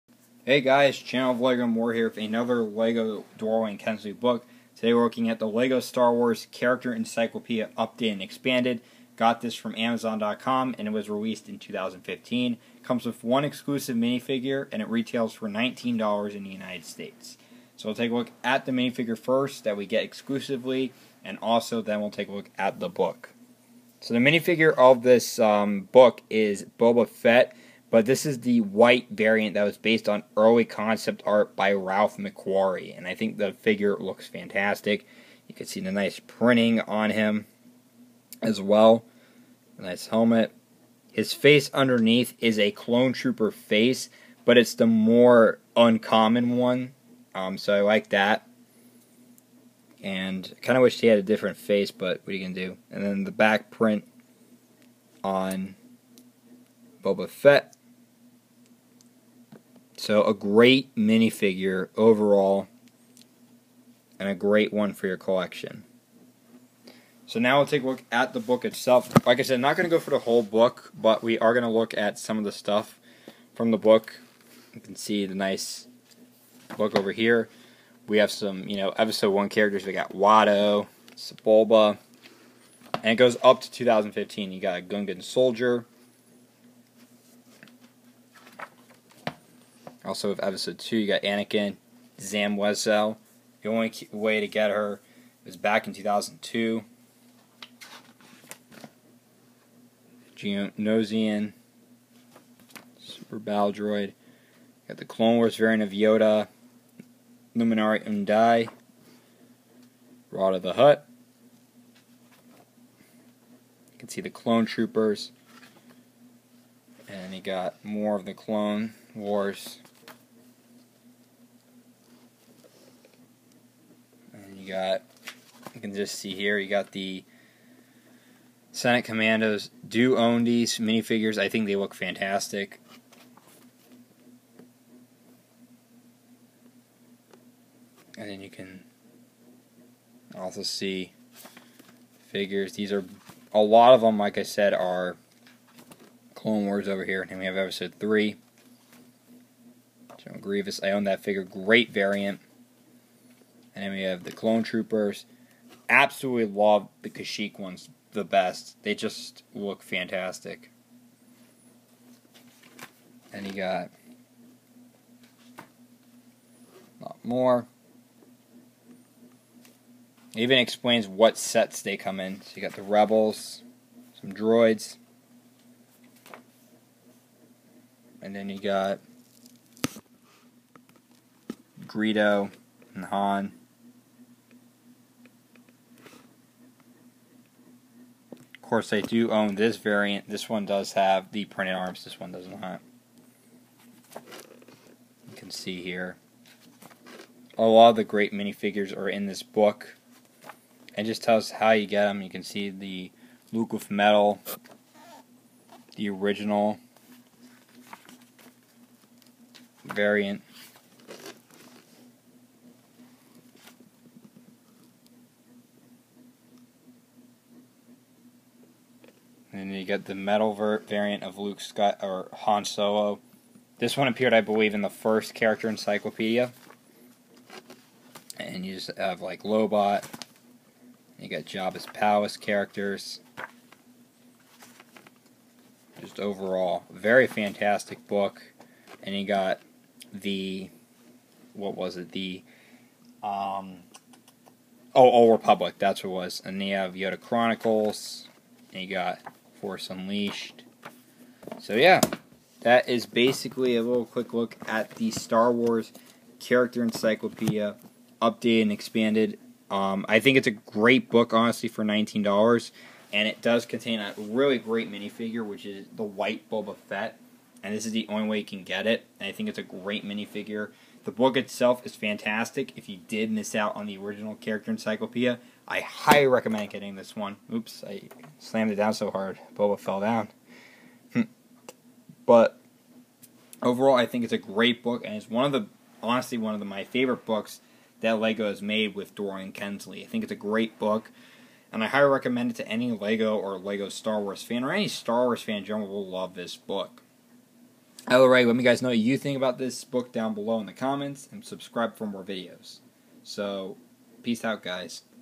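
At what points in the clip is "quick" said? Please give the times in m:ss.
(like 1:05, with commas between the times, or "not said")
4:14.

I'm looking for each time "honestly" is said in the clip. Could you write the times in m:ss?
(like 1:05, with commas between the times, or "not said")
4:21, 4:46.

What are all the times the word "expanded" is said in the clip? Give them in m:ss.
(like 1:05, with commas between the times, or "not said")
0:08, 4:18.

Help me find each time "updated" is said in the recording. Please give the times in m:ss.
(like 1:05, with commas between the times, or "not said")
0:07, 4:18.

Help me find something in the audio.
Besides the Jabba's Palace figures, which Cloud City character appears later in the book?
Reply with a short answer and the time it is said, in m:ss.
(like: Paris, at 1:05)
Lobot, at 3:49.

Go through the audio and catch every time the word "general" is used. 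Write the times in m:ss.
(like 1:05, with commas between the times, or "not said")
2:30, 4:55.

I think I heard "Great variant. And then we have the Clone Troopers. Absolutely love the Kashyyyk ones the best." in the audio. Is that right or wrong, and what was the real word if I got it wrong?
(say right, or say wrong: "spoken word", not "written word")
right.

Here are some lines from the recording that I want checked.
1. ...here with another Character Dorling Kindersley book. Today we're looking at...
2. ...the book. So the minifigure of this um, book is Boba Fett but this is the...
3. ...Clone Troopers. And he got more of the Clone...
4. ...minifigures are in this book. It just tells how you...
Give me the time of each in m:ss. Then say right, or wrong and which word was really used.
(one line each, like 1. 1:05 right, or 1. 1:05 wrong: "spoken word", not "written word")
1. 0:01 wrong: "LEGO", not "Character"
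2. 0:22 right
3. 1:54 right
4. 3:18 right.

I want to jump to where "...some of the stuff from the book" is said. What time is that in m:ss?
1:12.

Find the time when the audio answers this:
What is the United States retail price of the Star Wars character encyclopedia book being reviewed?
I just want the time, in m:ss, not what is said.
0:15.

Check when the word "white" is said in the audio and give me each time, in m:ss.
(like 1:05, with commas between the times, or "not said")
0:28, 4:26.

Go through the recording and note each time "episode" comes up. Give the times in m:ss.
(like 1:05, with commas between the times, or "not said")
1:18, 1:30, 2:27.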